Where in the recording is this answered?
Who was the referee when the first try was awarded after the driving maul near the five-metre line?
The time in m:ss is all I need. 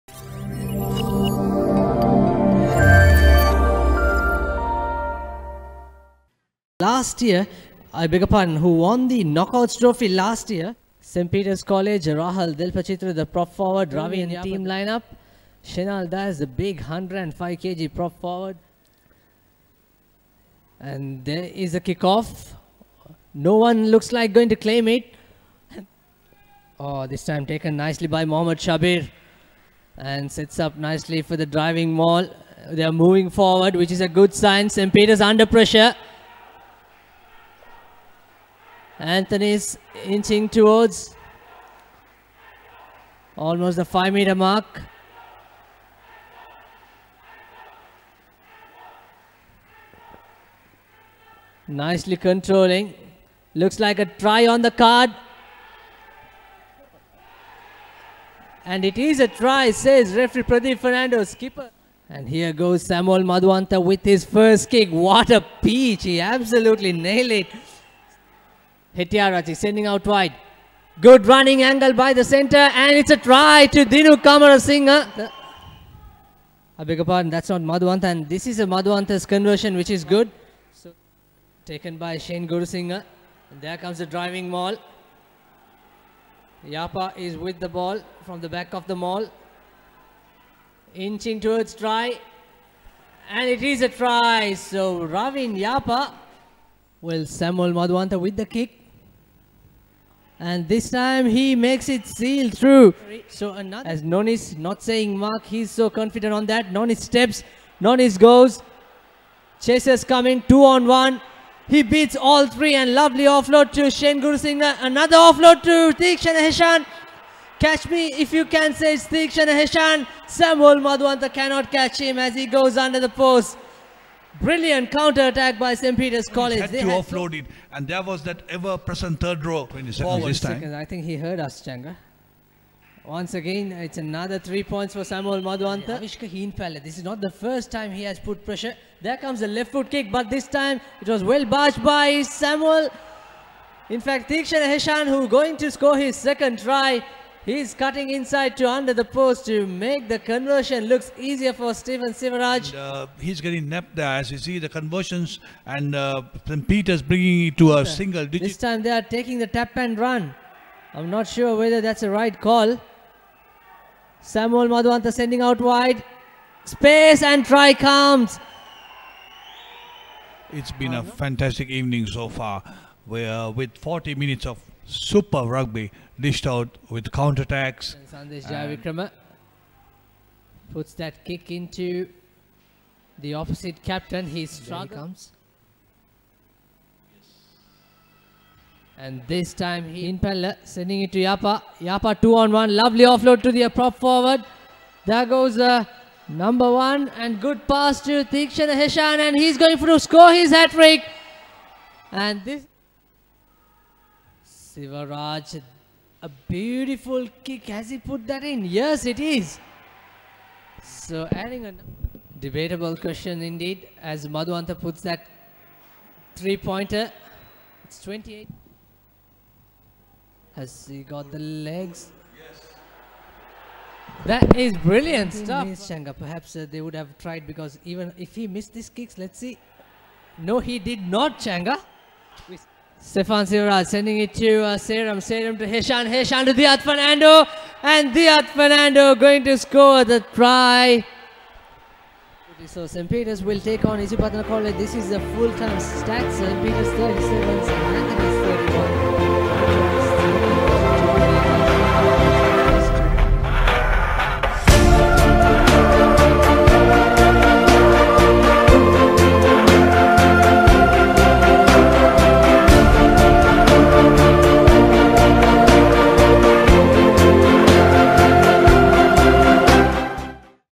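1:00.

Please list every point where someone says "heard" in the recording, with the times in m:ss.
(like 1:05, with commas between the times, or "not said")
2:11.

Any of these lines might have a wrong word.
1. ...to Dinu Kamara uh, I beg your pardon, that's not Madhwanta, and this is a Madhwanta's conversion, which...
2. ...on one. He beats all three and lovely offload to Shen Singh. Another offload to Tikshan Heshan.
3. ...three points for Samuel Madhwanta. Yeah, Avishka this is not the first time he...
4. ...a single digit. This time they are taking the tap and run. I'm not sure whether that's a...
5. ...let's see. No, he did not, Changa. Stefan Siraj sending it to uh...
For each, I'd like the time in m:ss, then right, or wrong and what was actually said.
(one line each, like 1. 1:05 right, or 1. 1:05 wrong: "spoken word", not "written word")
1. 1:13 right
2. 1:50 right
3. 2:14 right
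4. 2:37 right
5. 3:49 right.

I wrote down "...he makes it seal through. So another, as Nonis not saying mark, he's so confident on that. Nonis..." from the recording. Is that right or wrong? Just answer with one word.
right.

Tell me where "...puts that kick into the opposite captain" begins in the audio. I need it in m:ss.
3:00.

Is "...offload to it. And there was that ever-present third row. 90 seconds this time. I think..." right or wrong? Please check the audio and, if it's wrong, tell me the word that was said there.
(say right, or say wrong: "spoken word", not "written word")
wrong: "20", not "90".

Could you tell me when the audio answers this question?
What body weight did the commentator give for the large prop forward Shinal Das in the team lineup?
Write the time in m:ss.
0:16.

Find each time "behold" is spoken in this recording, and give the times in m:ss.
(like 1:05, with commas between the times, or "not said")
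not said.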